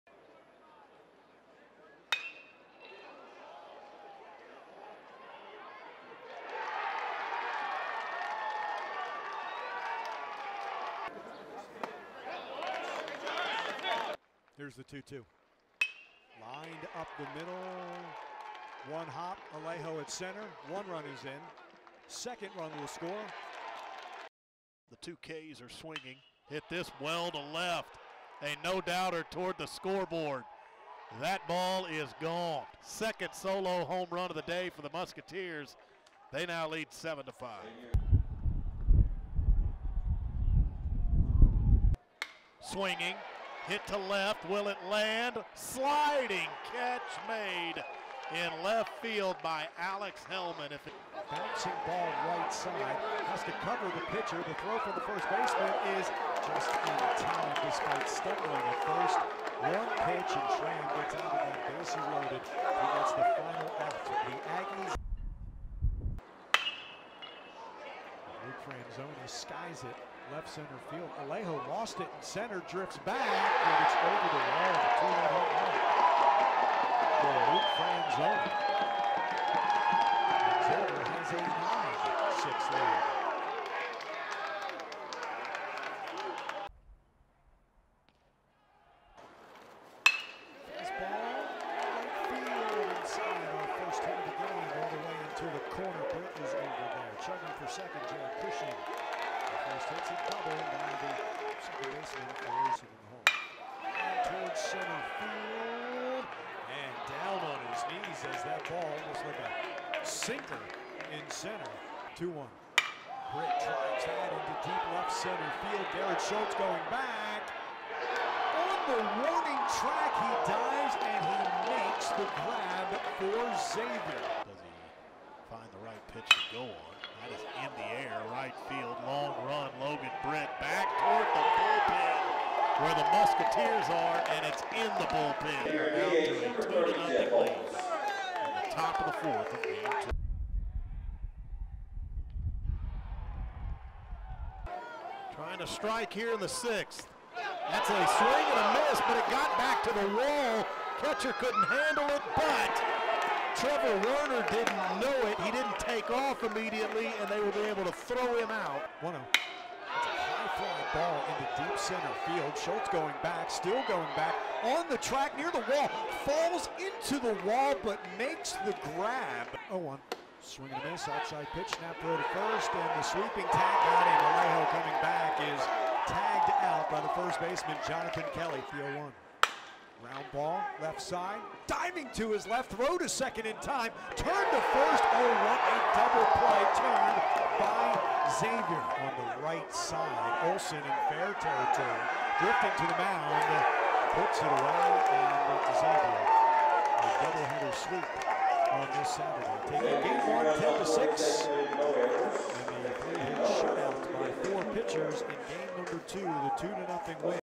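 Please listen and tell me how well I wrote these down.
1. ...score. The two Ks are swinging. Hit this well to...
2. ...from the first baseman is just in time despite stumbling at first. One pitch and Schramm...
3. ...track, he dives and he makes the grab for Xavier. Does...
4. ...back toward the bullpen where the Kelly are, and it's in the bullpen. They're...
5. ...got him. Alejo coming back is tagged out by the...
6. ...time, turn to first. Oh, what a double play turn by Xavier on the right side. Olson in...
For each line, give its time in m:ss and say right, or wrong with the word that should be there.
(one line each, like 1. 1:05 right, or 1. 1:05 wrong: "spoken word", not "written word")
1. 0:22 right
2. 0:54 right
3. 1:59 right
4. 2:10 wrong: "Musketeers", not "Kelly"
5. 2:53 right
6. 3:03 right.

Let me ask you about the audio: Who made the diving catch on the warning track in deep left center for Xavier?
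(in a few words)
Garrett Schultz.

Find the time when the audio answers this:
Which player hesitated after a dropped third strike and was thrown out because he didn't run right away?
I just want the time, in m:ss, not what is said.
2:33.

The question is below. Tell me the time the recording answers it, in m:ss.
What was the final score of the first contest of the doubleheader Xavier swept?
3:20.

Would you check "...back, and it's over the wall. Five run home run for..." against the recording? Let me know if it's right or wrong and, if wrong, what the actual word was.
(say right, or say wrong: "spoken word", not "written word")
wrong: "Two", not "Five".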